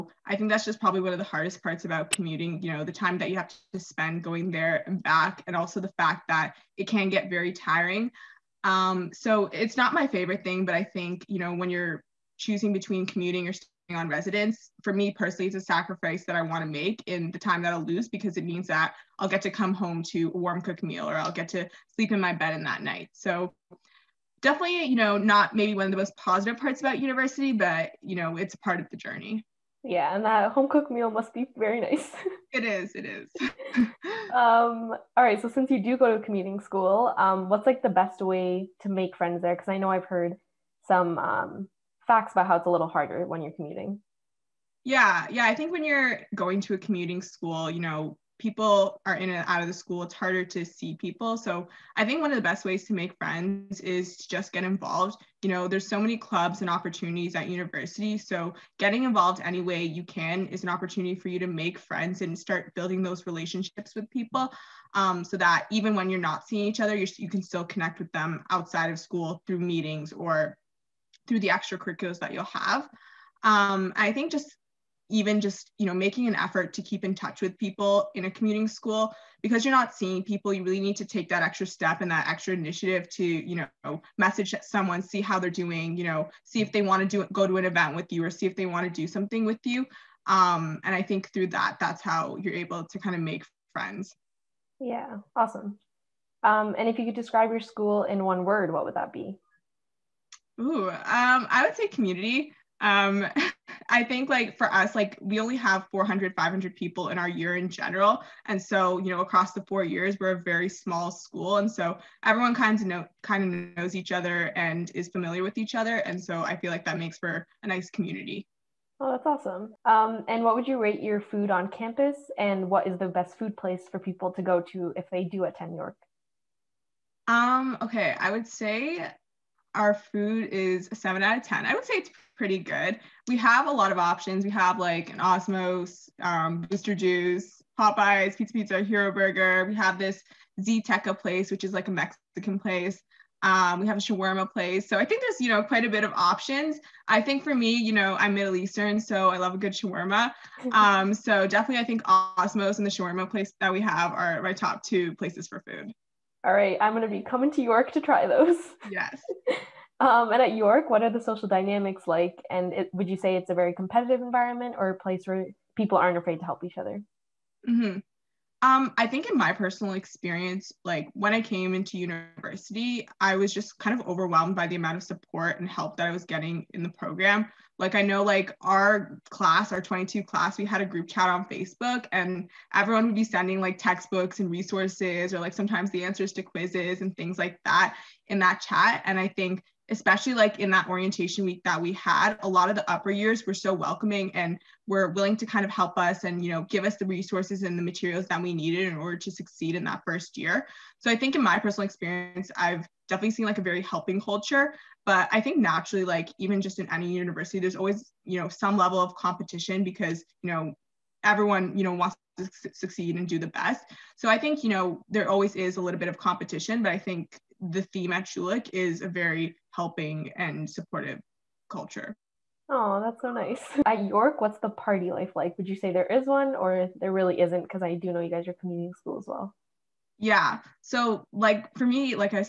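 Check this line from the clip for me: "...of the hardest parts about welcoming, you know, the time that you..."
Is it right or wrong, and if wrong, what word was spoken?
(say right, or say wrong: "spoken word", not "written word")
wrong: "commuting", not "welcoming".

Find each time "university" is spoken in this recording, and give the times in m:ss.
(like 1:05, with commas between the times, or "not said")
0:26, 0:57, 2:51, 3:27.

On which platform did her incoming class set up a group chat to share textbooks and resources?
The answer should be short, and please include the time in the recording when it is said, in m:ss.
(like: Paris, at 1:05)
Facebook, at 3:01.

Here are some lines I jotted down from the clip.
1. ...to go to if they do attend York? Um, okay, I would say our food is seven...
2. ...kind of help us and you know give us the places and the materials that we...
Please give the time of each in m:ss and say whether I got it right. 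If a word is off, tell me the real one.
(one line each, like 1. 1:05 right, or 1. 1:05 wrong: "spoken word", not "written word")
1. 2:04 right
2. 3:15 wrong: "resources", not "places".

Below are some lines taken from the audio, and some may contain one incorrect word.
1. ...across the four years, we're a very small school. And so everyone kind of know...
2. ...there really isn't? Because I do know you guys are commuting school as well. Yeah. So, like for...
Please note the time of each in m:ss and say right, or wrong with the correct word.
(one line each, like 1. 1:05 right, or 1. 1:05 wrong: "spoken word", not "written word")
1. 1:49 right
2. 3:46 right.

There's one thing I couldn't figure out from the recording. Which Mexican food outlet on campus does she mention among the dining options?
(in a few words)
Zteca.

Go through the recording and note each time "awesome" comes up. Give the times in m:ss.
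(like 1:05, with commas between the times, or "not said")
1:35, 1:59.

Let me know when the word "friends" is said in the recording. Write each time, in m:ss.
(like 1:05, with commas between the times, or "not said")
0:39, 0:53, 1:01, 1:33.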